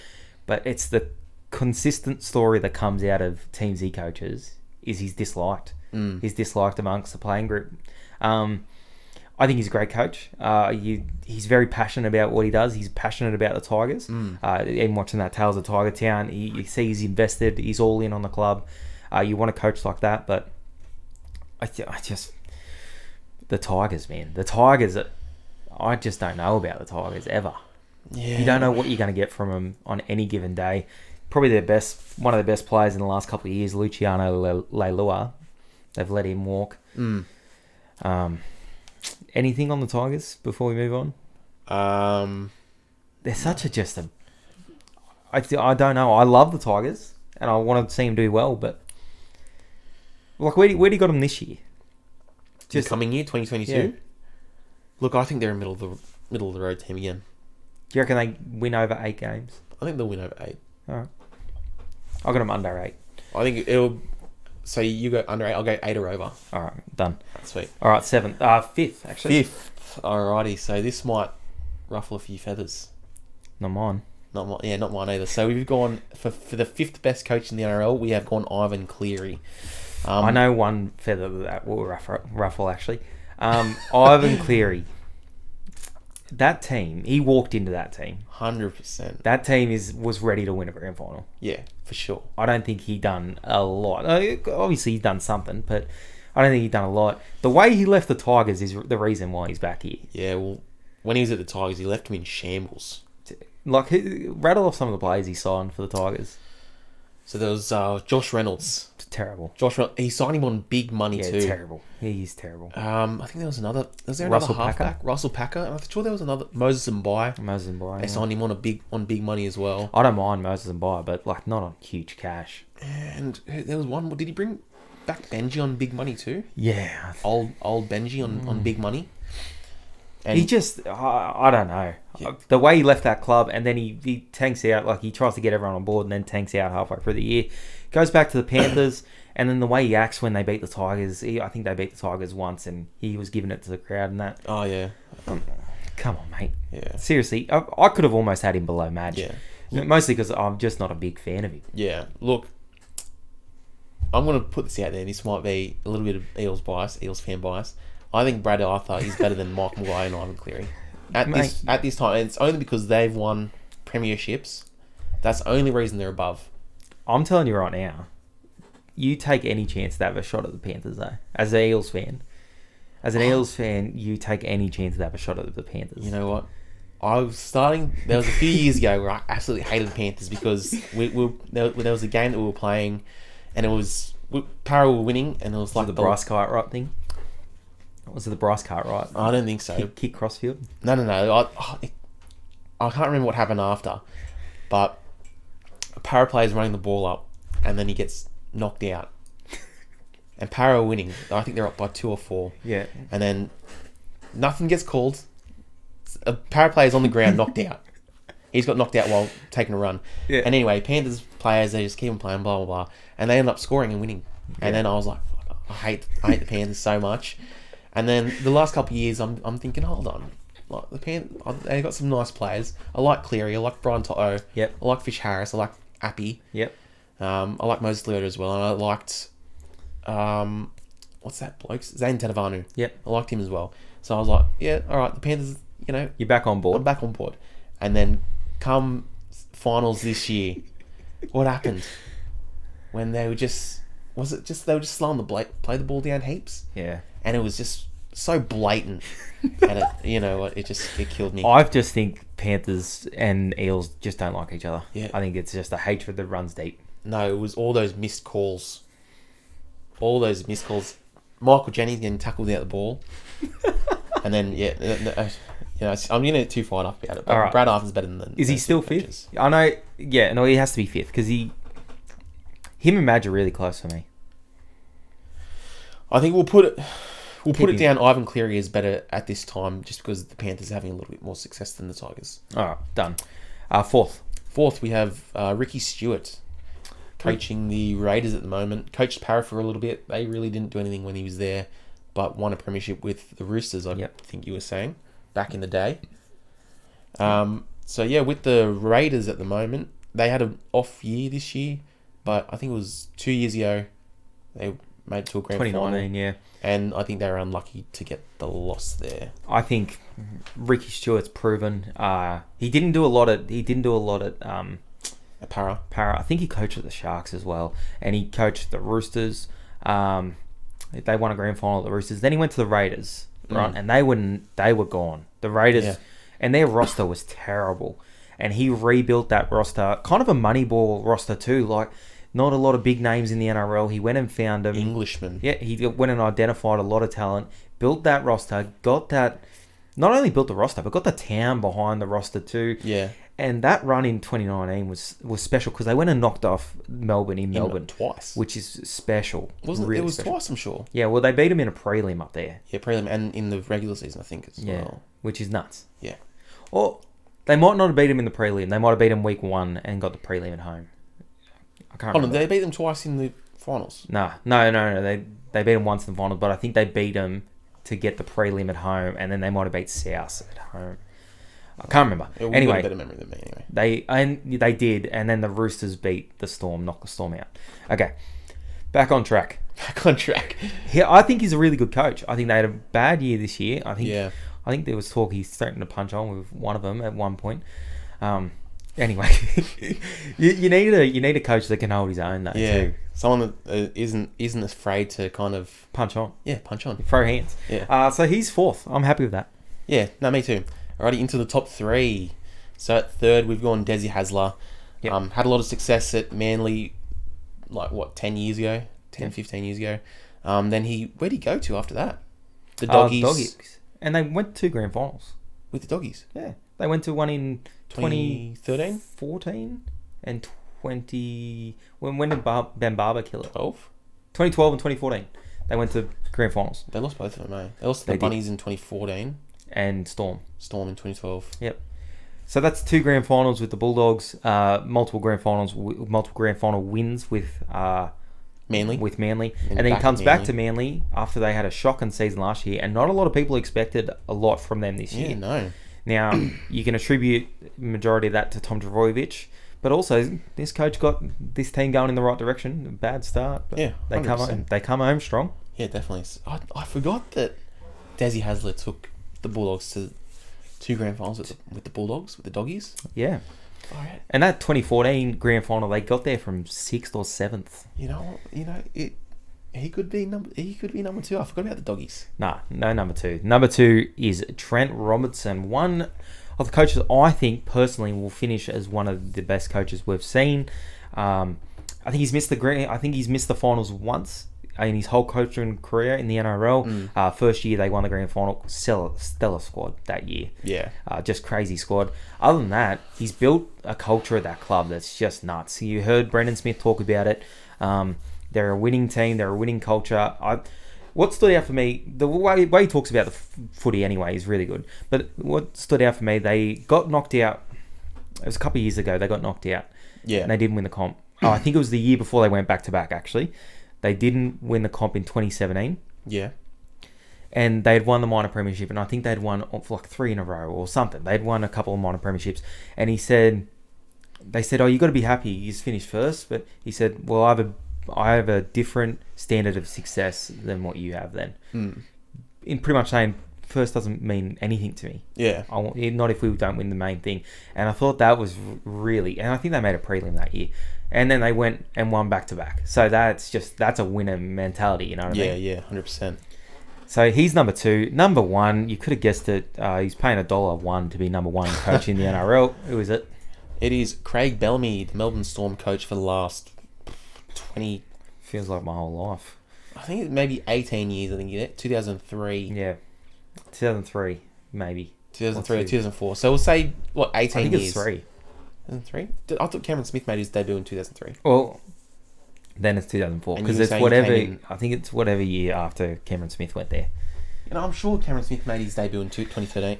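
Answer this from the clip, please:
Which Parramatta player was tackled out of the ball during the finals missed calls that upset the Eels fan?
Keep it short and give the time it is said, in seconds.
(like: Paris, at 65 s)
Michael Jennings, at 261 s.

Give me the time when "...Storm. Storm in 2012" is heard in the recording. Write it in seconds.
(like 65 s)
430 s.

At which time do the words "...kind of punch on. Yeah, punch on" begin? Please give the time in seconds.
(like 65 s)
395 s.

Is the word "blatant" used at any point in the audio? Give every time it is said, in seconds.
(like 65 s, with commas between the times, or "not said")
248 s.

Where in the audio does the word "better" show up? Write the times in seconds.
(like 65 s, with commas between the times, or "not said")
159 s, 267 s, 278 s, 372 s.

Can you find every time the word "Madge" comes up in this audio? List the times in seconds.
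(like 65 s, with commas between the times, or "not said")
148 s, 273 s.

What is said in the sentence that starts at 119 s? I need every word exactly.
I don't mind Moses Mbye, but like not on huge cash.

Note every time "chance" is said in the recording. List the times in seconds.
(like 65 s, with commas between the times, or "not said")
169 s, 174 s.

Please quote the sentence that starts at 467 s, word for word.
You know, you know, it, he could be number.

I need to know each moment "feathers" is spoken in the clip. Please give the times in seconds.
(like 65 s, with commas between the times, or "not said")
72 s, 80 s.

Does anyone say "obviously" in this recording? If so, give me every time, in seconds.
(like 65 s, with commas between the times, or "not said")
94 s.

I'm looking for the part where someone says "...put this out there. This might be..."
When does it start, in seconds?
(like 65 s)
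154 s.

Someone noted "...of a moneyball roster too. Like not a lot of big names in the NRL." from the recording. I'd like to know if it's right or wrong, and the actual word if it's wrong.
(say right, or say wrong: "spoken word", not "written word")
right.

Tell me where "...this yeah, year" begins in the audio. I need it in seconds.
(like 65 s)
444 s.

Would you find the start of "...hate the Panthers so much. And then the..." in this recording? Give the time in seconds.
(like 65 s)
216 s.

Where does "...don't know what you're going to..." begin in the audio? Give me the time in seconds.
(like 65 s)
28 s.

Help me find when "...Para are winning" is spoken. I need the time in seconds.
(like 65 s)
200 s.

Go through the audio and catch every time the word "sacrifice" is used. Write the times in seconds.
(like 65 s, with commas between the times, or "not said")
not said.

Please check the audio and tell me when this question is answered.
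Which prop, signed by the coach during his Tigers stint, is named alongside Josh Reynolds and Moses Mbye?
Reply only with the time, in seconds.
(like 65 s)
115 s.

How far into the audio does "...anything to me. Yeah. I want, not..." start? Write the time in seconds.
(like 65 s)
534 s.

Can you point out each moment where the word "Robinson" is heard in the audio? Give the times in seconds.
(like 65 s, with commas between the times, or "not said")
474 s.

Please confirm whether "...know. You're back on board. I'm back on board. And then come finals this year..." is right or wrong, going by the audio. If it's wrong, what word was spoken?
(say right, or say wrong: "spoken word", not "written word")
right.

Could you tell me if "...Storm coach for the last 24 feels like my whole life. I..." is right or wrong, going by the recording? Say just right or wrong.
wrong.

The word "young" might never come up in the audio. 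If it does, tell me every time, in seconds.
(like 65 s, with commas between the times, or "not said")
not said.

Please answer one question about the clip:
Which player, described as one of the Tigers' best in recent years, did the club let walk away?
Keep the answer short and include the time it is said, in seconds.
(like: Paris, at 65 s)
Luciano Leilua, at 33 s.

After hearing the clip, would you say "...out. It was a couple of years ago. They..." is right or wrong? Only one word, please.
right.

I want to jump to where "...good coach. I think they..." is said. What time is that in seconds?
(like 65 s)
381 s.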